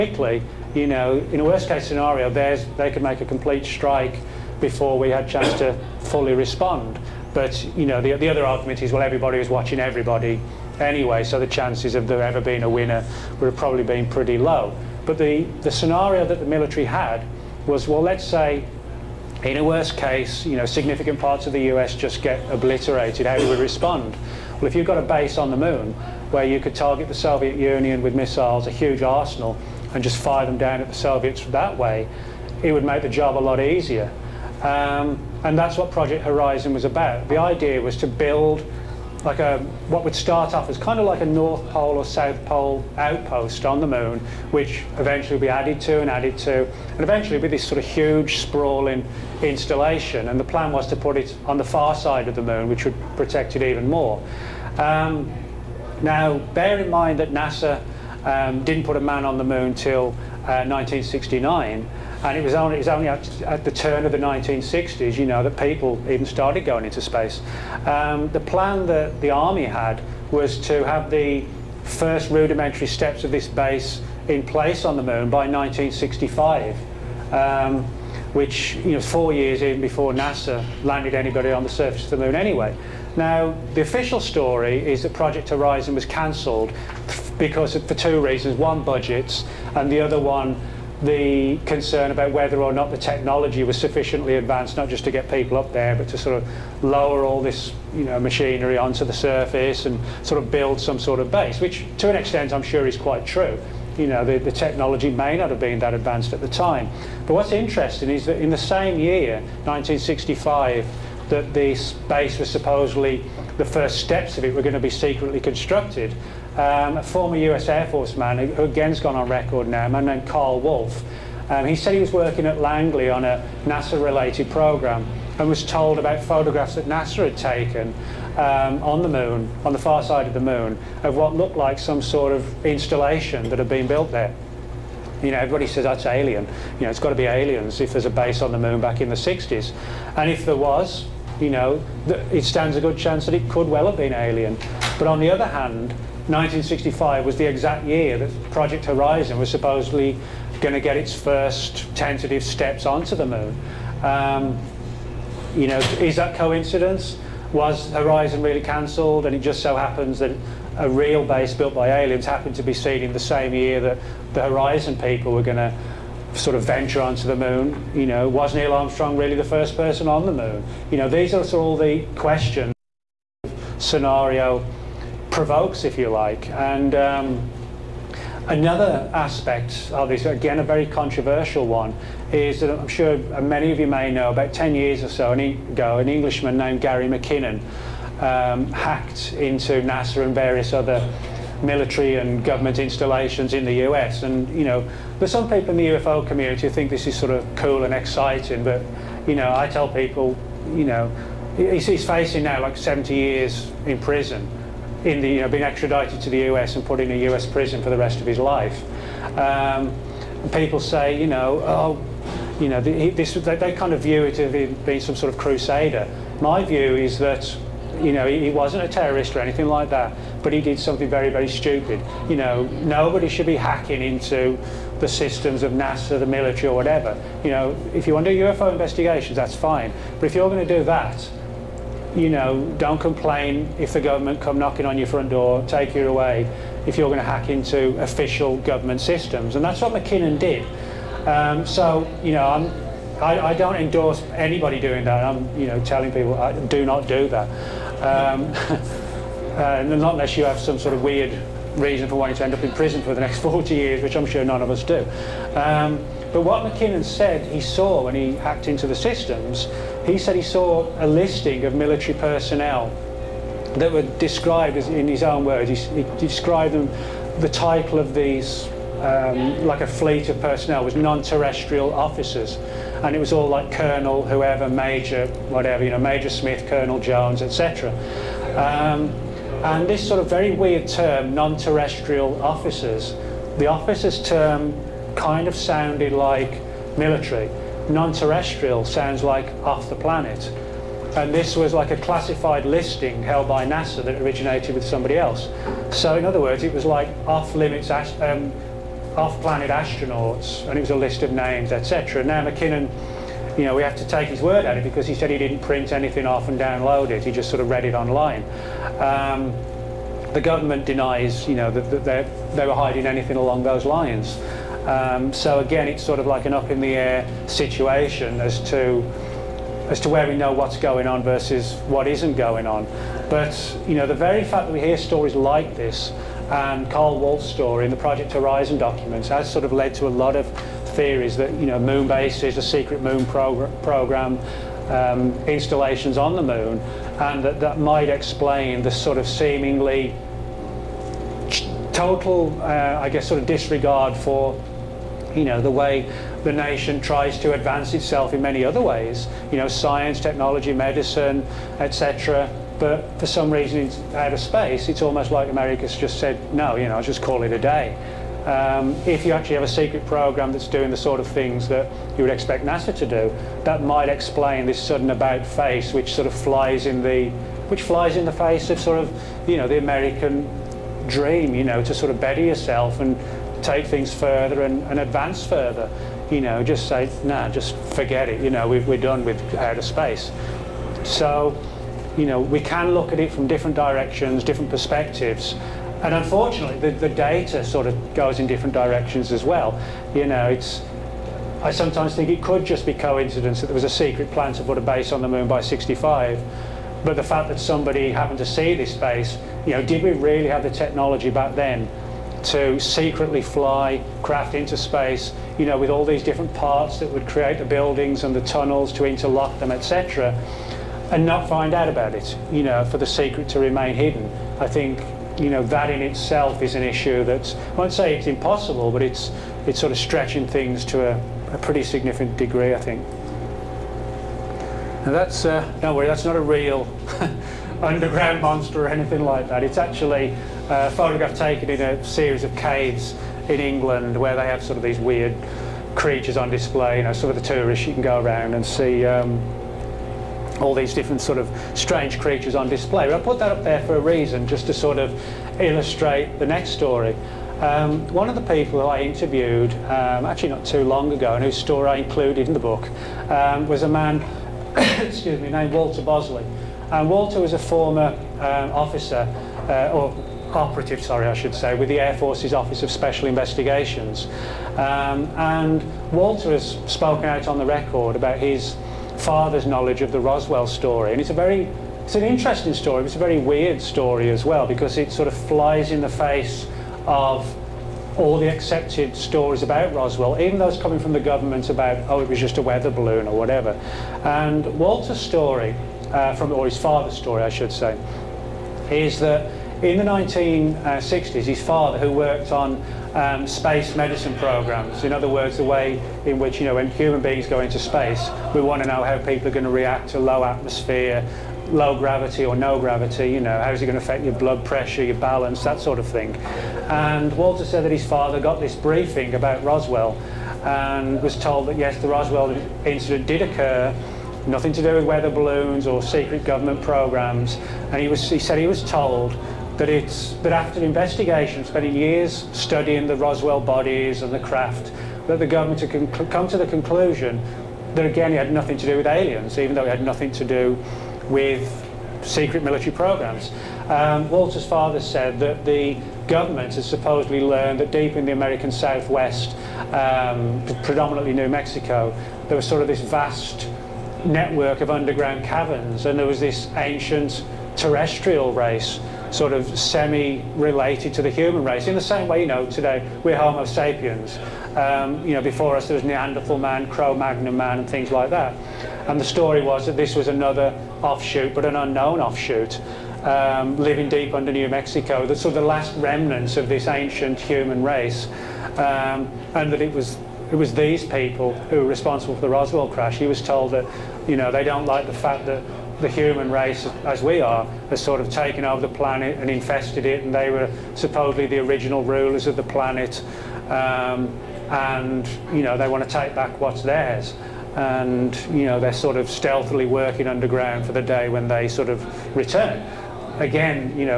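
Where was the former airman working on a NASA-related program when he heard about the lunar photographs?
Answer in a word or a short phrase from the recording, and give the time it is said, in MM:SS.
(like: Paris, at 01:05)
Langley, at 02:02.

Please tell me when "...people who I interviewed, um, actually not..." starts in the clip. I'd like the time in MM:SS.
07:28.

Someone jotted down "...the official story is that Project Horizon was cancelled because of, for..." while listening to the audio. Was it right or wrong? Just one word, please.
right.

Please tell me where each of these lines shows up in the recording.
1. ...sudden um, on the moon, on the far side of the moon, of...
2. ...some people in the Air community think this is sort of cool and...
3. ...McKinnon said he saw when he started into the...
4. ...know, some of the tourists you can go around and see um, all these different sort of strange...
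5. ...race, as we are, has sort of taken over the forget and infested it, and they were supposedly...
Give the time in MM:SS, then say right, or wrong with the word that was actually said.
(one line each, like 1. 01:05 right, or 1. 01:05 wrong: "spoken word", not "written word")
1. 02:07 wrong: "taken", not "sudden"
2. 03:15 wrong: "UFO", not "Air"
3. 04:16 wrong: "hacked", not "started"
4. 07:17 right
5. 09:36 wrong: "planet", not "forget".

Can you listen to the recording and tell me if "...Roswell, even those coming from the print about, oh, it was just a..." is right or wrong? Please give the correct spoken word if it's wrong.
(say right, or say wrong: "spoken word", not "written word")
wrong: "government", not "print".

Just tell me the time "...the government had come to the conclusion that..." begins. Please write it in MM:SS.
08:45.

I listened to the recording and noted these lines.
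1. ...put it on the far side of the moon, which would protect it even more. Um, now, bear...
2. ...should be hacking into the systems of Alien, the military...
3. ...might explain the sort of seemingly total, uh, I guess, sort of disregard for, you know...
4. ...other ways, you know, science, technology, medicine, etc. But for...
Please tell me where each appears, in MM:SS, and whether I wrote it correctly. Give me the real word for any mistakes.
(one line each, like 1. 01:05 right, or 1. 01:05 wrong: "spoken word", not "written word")
1. 00:50 right
2. 03:43 wrong: "NASA", not "Alien"
3. 05:37 right
4. 05:48 right.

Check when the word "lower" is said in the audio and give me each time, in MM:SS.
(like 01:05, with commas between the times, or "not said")
01:36.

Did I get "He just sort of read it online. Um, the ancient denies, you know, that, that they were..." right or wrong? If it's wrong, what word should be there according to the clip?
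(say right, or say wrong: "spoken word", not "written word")
wrong: "government", not "ancient".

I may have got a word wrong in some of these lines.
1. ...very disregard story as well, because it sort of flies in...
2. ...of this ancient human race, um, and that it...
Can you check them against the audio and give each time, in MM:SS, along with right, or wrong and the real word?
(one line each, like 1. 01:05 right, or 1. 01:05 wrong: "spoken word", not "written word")
1. 07:53 wrong: "weird", not "disregard"
2. 09:26 right.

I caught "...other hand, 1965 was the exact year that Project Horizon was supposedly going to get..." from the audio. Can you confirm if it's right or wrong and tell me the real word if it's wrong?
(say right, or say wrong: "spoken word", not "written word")
right.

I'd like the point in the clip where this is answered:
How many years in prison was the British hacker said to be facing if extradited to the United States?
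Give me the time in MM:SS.
03:22.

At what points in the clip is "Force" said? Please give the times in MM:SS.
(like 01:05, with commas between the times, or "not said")
01:57, 07:42.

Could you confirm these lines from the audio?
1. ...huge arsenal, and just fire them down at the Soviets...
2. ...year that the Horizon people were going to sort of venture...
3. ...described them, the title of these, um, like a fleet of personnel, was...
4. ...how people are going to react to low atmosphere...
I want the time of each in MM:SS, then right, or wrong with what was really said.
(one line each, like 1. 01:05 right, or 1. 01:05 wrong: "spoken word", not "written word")
1. 00:28 right
2. 02:43 right
3. 04:26 right
4. 08:19 right.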